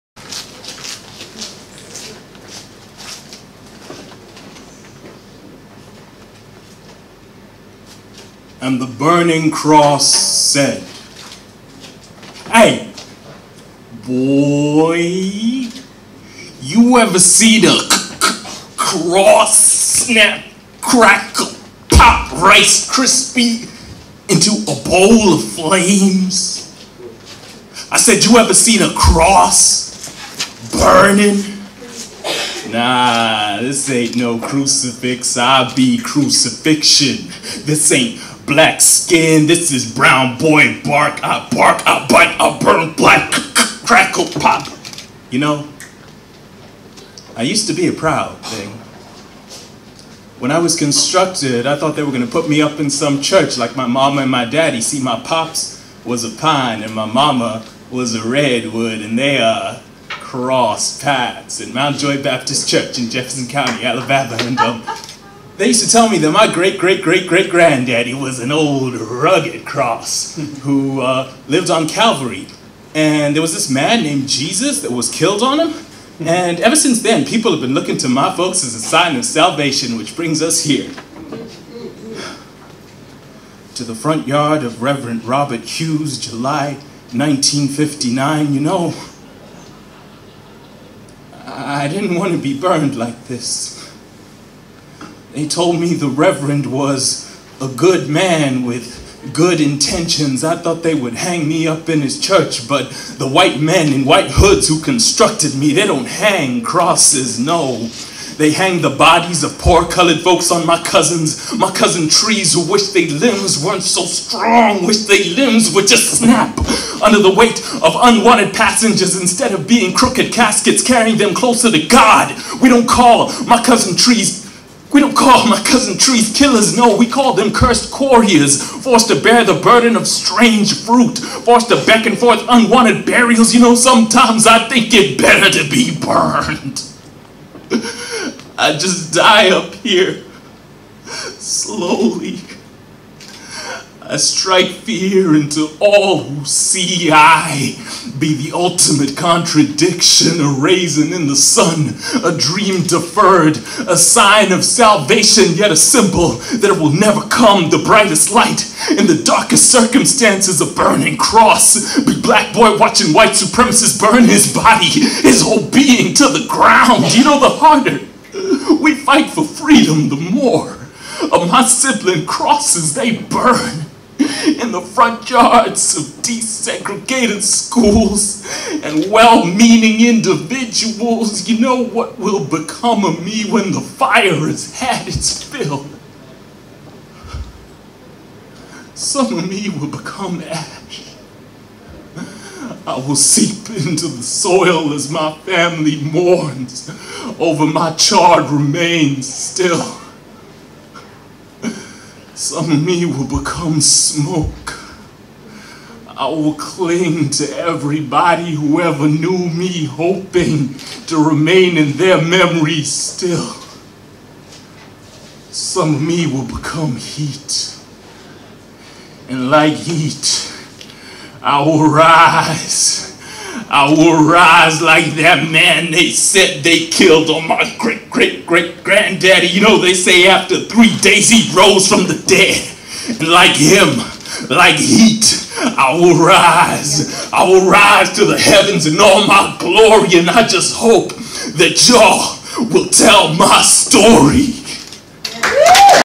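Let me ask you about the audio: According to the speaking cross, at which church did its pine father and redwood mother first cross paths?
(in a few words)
Mount Joy Baptist Church.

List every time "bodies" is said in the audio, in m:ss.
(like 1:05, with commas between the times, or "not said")
1:48.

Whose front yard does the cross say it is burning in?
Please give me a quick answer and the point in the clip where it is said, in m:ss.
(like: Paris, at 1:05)
Reverend Robert Hughes, at 1:24.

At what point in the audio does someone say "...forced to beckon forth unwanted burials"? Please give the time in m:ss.
2:11.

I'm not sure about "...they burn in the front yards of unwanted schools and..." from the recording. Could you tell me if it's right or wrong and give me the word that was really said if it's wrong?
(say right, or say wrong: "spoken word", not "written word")
wrong: "desegregated", not "unwanted".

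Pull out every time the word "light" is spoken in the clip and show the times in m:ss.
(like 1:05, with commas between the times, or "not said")
2:38.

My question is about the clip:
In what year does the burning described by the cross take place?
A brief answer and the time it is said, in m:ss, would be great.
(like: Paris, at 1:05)
1959, at 1:27.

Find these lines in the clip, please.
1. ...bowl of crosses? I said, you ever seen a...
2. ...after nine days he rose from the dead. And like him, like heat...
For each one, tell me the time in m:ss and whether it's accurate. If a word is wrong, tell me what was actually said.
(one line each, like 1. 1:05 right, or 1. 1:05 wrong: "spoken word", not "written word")
1. 0:24 wrong: "flames", not "crosses"
2. 3:50 wrong: "three", not "nine".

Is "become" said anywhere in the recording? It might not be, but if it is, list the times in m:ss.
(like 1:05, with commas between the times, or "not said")
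3:02, 3:09, 3:23, 3:36.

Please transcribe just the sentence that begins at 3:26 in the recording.
I will cling to everybody who ever knew me, hoping to remain in their memories still.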